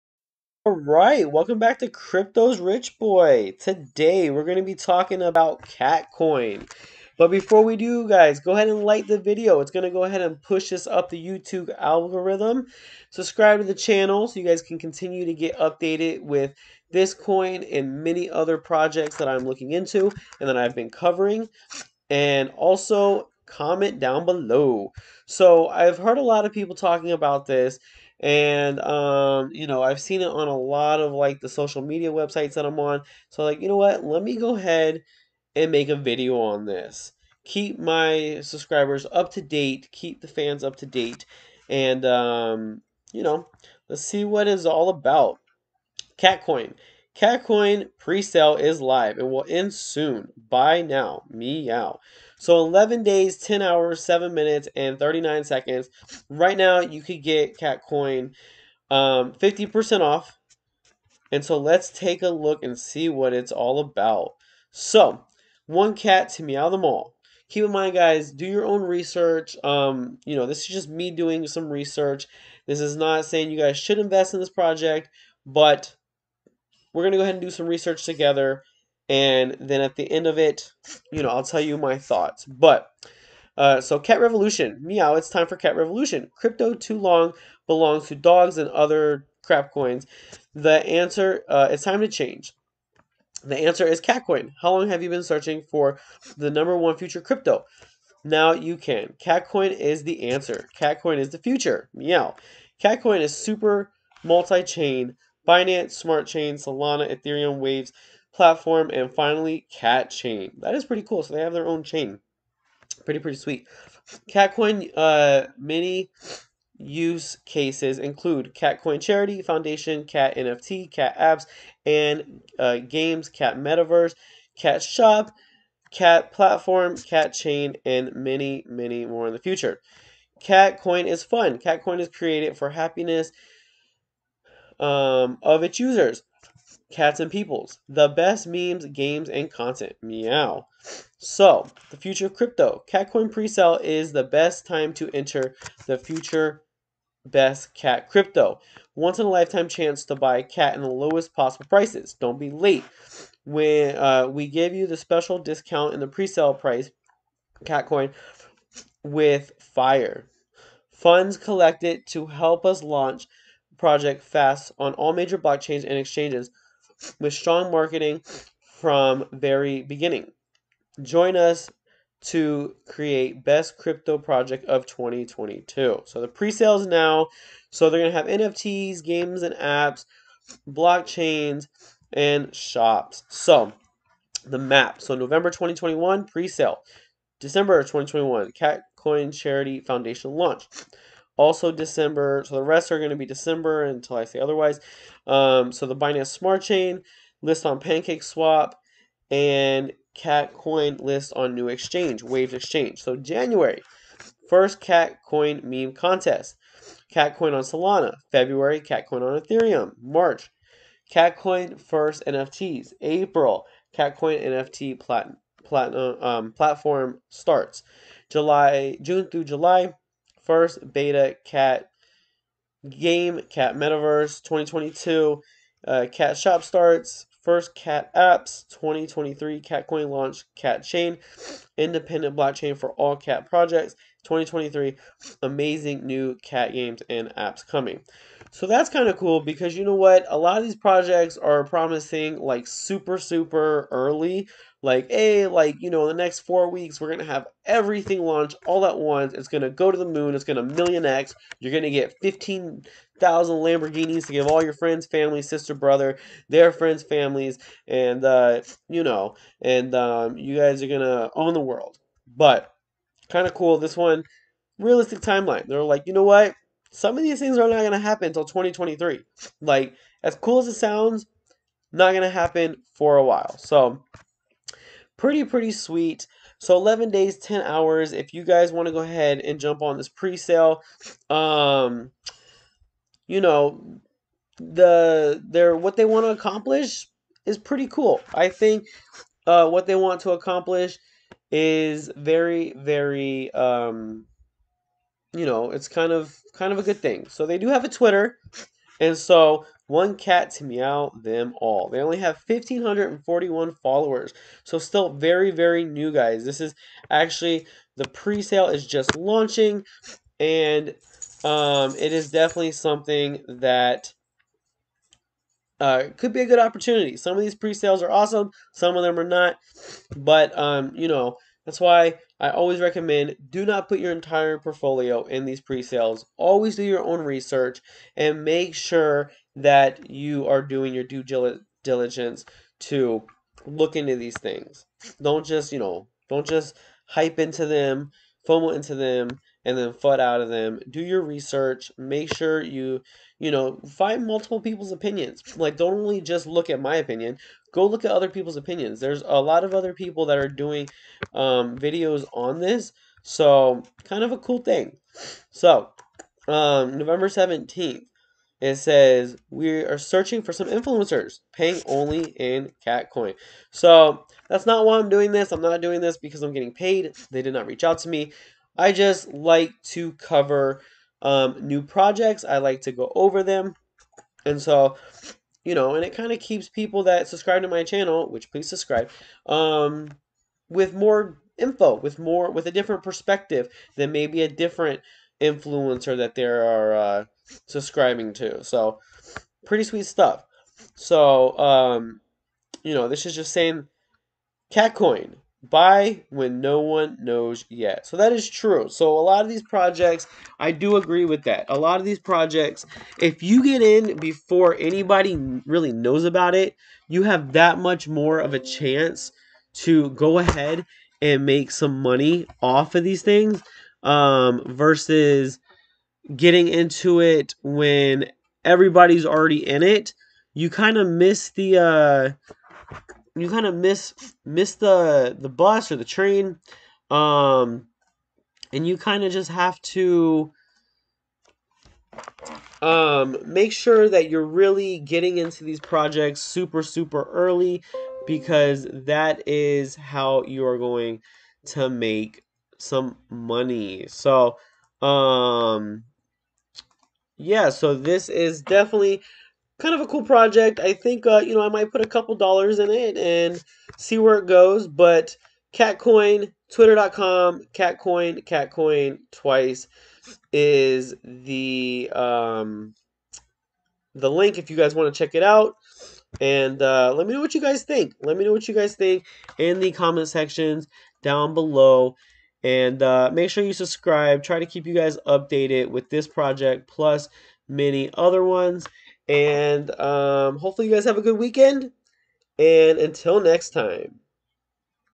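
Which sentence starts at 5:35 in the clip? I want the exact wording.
Don't just, you know, don't just hype into them, FOMO into them, and then FUD out of them.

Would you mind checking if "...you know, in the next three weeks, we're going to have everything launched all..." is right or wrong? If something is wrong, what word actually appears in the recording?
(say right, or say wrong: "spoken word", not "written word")
wrong: "four", not "three".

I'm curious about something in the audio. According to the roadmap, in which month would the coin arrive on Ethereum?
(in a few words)
February.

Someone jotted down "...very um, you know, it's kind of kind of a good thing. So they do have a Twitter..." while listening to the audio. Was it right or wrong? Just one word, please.
right.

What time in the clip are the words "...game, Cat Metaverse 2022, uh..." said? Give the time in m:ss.
3:42.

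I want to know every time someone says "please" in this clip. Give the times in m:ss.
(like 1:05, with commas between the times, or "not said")
6:18.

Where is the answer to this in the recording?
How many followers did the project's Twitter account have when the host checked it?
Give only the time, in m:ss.
5:02.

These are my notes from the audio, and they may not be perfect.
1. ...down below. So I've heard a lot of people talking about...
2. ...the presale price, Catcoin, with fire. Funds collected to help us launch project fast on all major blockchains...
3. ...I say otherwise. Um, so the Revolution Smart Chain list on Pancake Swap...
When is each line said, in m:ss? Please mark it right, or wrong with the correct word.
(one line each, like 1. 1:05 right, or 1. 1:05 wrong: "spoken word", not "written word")
1. 0:23 right
2. 2:35 right
3. 3:14 wrong: "Binance", not "Revolution".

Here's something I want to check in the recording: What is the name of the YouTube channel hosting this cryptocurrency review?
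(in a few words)
Crypto's Rich Boy.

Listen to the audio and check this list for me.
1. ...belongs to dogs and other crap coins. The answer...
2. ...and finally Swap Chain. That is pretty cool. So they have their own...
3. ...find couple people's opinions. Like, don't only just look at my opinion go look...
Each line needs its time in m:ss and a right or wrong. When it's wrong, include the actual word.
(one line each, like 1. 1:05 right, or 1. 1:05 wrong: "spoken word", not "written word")
1. 1:27 right
2. 1:48 wrong: "Cat", not "Swap"
3. 5:43 wrong: "multiple", not "couple".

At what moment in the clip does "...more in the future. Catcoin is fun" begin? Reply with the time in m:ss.
2:09.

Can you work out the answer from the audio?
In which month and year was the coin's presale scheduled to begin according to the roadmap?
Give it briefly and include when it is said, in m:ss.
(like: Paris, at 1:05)
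November 2021, at 3:05.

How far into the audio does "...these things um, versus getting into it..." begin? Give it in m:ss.
6:53.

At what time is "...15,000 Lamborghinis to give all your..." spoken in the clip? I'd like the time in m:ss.
4:12.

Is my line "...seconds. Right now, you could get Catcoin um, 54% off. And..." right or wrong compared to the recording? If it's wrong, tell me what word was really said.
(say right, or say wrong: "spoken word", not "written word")
wrong: "50", not "54".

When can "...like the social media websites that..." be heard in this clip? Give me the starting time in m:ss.
0:31.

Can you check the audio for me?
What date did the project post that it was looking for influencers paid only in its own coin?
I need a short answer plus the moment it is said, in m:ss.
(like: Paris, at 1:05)
November 17th, at 5:56.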